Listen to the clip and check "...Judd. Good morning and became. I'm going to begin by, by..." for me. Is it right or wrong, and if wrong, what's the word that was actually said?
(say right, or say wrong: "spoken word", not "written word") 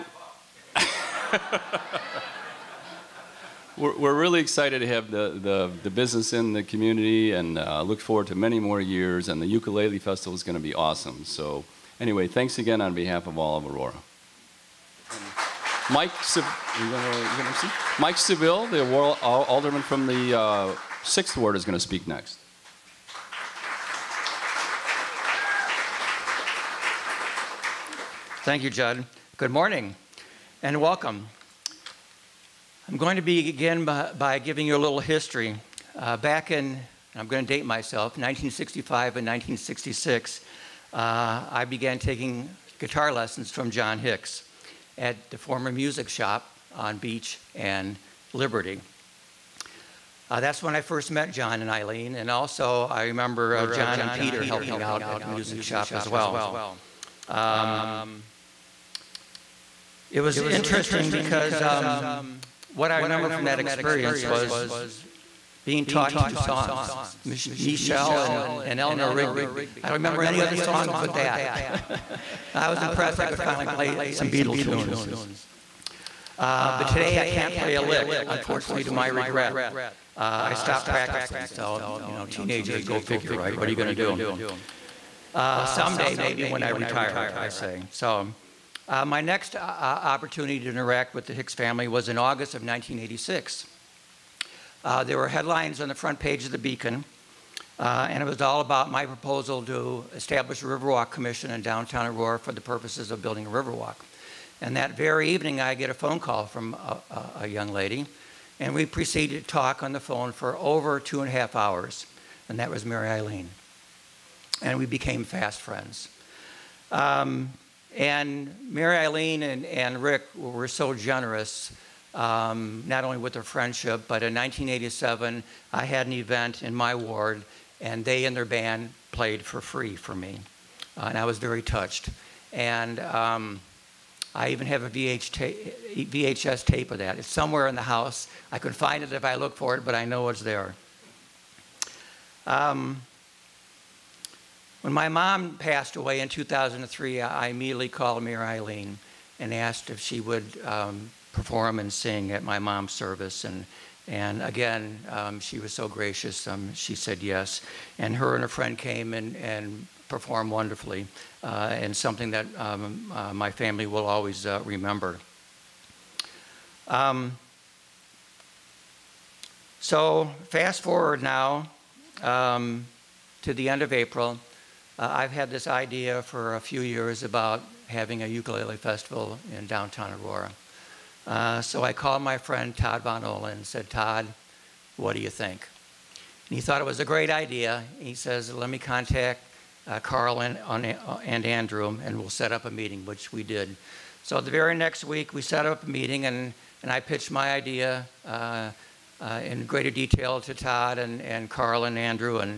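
wrong: "welcome", not "became".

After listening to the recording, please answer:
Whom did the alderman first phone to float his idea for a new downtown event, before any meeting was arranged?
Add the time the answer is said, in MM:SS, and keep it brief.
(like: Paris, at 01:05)
Todd Von Olin, at 03:02.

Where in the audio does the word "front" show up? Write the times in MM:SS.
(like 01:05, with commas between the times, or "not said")
01:35.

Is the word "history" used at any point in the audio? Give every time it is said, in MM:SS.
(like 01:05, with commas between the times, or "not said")
00:34.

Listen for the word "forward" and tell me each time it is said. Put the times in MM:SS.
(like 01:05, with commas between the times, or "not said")
00:07, 02:50.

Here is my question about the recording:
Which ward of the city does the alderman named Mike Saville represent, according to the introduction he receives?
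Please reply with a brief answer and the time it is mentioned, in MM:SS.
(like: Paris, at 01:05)
6th Ward, at 00:21.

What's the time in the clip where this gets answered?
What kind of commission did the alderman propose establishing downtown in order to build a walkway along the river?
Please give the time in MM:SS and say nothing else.
01:40.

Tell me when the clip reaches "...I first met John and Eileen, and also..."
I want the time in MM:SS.
00:50.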